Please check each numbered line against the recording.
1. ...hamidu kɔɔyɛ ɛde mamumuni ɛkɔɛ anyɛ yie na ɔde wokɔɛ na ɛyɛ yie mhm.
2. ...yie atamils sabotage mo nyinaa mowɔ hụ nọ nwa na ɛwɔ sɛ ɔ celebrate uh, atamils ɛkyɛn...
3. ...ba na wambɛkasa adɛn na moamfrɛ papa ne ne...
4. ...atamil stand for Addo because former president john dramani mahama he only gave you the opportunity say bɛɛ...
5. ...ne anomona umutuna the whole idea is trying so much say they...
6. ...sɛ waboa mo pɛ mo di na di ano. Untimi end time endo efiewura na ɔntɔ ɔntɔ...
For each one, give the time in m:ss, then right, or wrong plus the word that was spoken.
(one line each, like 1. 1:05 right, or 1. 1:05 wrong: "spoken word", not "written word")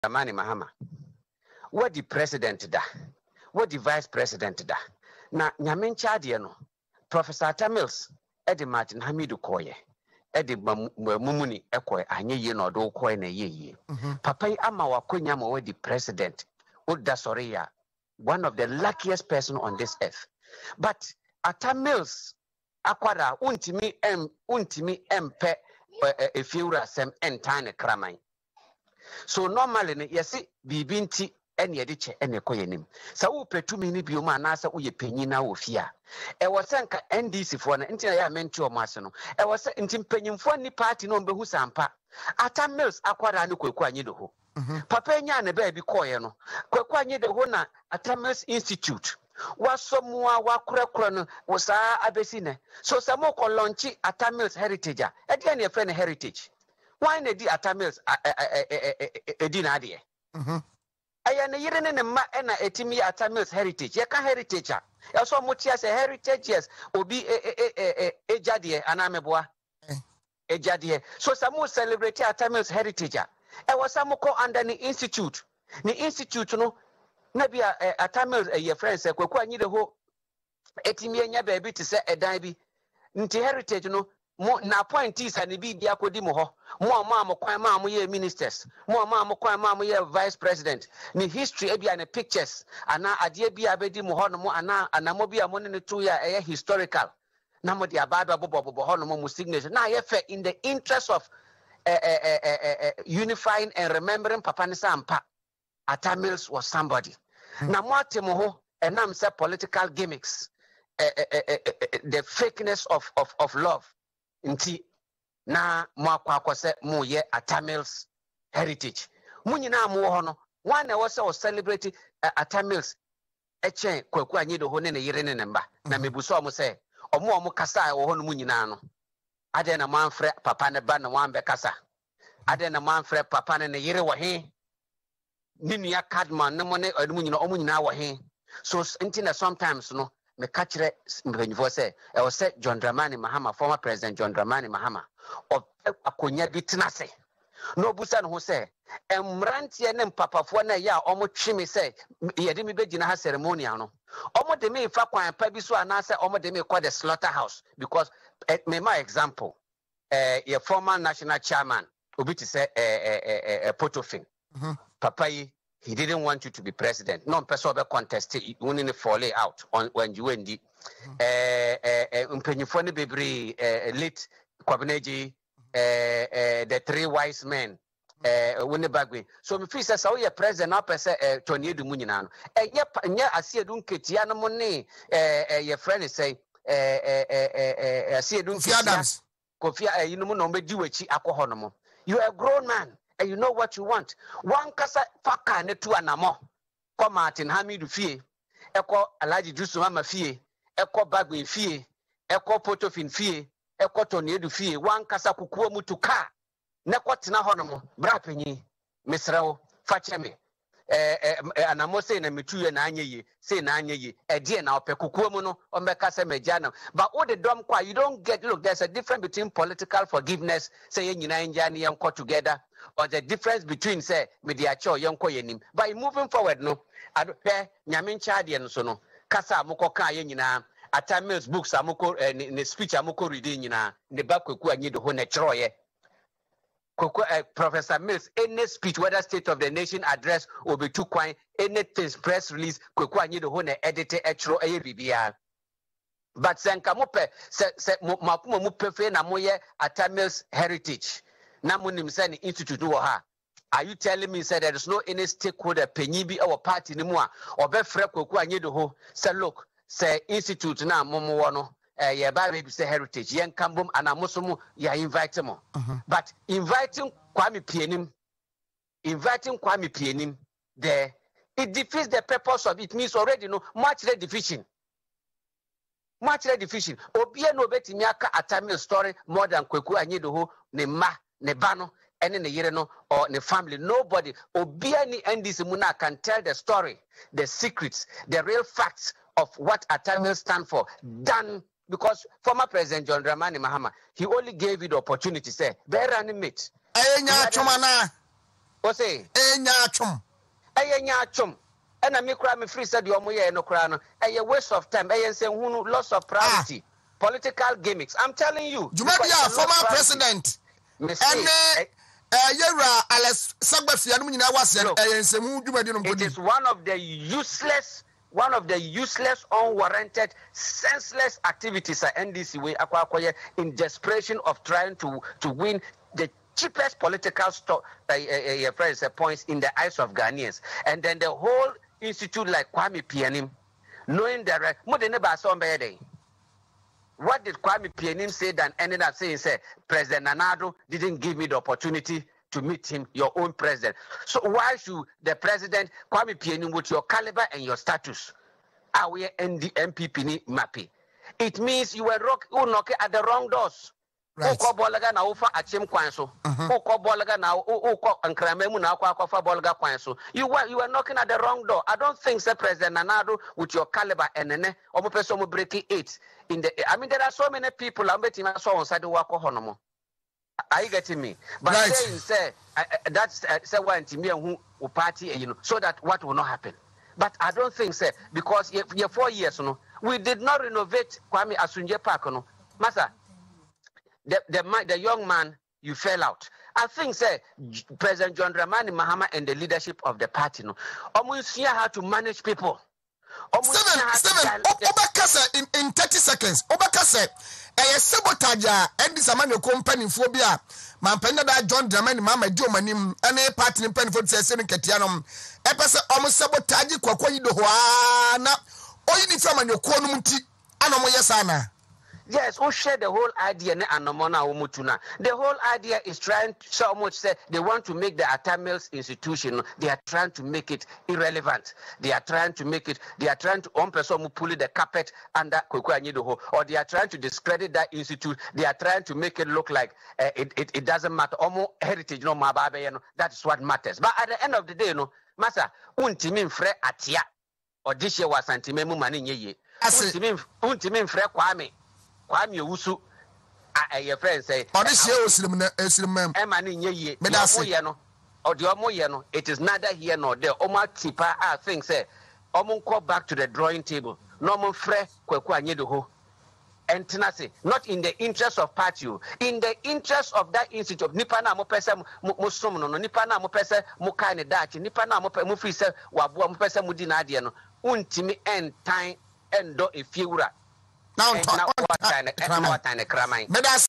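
1. 0:09 right
2. 1:57 wrong: "heritage", not "sabotage"
3. 2:10 right
4. 4:49 wrong: "Done", not "Addo"
5. 6:53 right
6. 7:45 right.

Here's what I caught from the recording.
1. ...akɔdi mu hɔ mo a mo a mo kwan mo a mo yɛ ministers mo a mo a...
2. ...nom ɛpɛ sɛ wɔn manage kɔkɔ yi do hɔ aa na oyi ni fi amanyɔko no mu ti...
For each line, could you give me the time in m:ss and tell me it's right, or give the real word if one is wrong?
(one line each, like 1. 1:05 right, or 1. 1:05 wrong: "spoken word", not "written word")
1. 1:25 right
2. 6:44 wrong: "sabotage", not "manage".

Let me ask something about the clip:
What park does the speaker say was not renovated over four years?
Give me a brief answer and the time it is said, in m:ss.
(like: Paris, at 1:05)
Kwame Asunje Park, at 6:21.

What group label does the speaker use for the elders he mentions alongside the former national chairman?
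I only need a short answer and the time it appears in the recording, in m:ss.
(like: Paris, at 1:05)
the three wise men, at 2:56.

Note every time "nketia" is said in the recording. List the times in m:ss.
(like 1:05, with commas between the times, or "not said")
3:03, 3:08.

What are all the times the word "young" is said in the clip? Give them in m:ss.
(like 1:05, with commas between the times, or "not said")
6:24.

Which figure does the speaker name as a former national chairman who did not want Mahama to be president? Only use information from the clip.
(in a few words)
Portuphy.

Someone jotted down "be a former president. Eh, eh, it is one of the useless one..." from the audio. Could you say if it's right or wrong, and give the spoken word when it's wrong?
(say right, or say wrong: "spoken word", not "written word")
right.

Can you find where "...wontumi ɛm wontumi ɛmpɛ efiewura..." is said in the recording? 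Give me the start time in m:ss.
0:23.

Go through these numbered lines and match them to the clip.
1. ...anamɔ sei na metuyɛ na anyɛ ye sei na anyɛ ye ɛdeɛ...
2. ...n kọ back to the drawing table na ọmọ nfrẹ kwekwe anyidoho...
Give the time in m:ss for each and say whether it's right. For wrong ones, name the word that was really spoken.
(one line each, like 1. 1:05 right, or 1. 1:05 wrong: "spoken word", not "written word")
1. 3:31 right
2. 7:32 right.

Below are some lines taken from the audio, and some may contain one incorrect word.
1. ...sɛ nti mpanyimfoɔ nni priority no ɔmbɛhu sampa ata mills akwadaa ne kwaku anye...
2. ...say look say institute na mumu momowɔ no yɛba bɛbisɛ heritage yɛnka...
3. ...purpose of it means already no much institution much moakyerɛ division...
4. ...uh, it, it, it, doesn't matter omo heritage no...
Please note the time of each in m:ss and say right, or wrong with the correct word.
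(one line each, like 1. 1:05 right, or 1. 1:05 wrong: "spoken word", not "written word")
1. 0:39 wrong: "party", not "priority"
2. 4:19 right
3. 4:32 wrong: "division", not "institution"
4. 7:10 right.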